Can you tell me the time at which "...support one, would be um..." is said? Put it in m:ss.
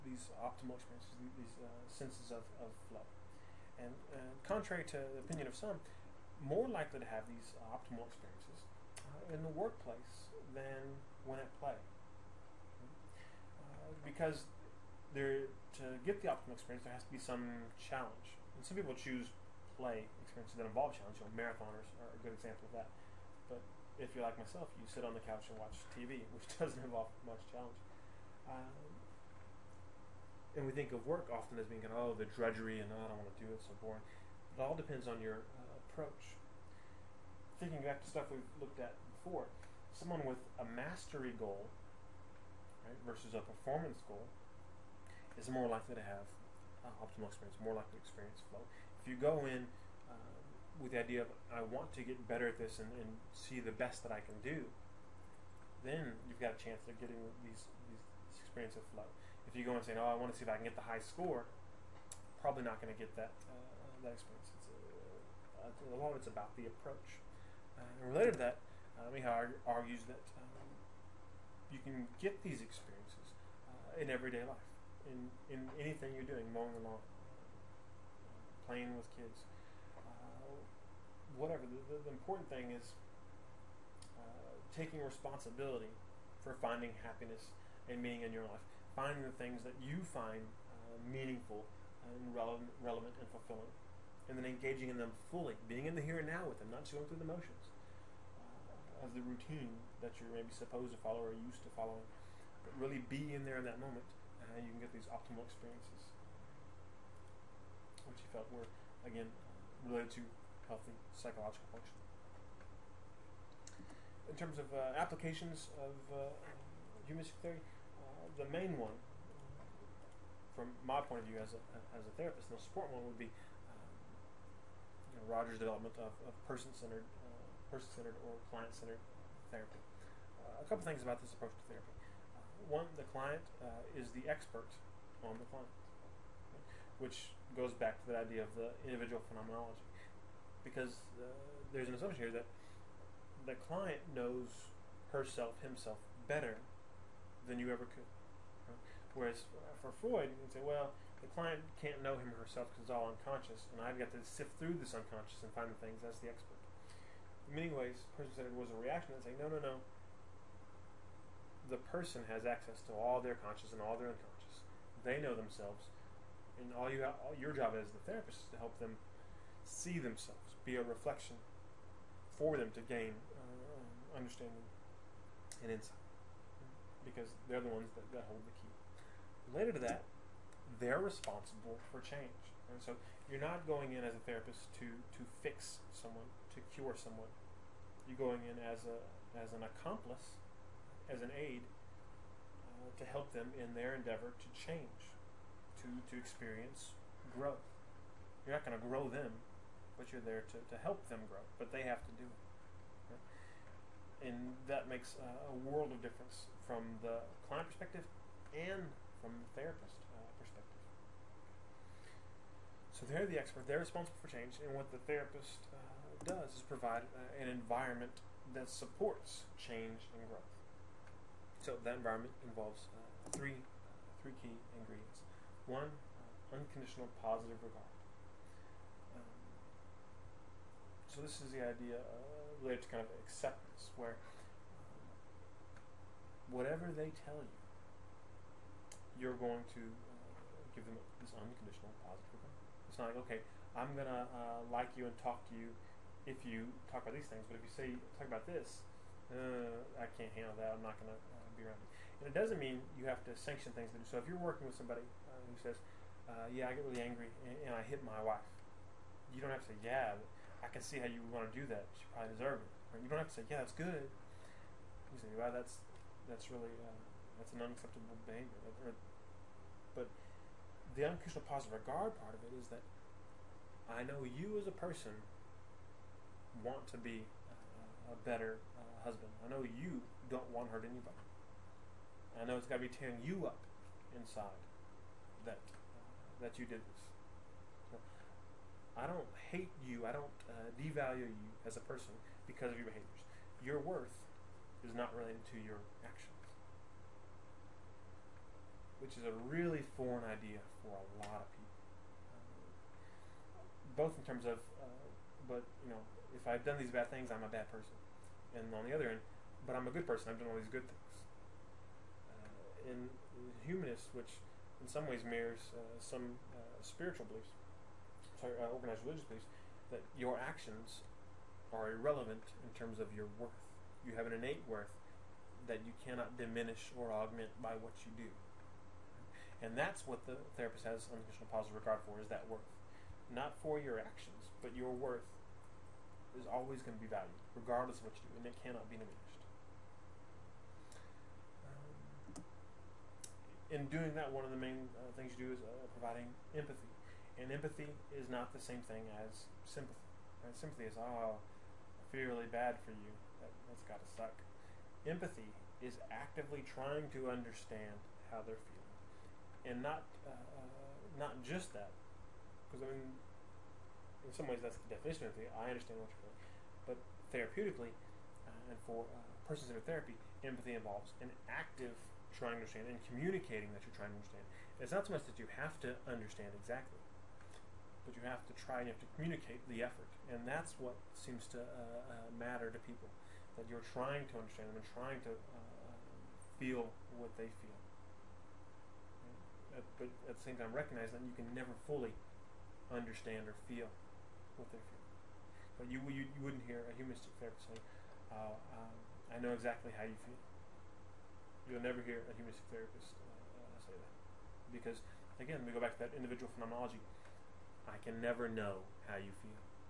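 2:02.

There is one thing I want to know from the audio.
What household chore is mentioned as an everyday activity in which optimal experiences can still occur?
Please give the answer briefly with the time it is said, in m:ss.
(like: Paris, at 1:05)
Mowing the lawn, at 1:16.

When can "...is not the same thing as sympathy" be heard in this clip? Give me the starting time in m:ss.
5:48.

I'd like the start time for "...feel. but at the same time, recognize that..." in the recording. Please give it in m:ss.
6:27.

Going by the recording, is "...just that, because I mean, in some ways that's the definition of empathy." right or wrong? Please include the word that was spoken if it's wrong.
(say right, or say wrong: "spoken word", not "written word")
right.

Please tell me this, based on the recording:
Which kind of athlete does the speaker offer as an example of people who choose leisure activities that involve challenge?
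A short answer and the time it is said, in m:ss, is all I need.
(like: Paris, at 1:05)
Marathoners, at 0:21.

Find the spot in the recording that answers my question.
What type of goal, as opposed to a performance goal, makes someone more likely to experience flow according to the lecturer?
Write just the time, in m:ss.
0:40.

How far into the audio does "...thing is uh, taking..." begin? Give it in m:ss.
1:22.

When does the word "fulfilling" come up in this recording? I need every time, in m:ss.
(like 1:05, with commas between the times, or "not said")
1:33.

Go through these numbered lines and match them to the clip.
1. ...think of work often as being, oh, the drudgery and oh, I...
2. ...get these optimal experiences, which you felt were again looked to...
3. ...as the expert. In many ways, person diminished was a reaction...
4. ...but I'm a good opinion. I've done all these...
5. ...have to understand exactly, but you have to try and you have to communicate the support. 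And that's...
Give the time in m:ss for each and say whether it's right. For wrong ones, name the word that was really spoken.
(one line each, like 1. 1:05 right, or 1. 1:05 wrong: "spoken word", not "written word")
1. 0:30 right
2. 1:44 wrong: "related", not "looked"
3. 2:36 wrong: "centered", not "diminished"
4. 5:09 wrong: "person", not "opinion"
5. 6:15 wrong: "effort", not "support".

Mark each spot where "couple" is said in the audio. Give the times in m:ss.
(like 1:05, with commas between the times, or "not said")
2:10.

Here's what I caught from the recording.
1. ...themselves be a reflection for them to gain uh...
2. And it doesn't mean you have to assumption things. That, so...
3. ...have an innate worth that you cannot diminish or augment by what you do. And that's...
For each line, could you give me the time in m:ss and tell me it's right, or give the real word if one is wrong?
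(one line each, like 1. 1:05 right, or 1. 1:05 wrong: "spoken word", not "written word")
1. 2:49 right
2. 4:12 wrong: "sanction", not "assumption"
3. 5:24 right.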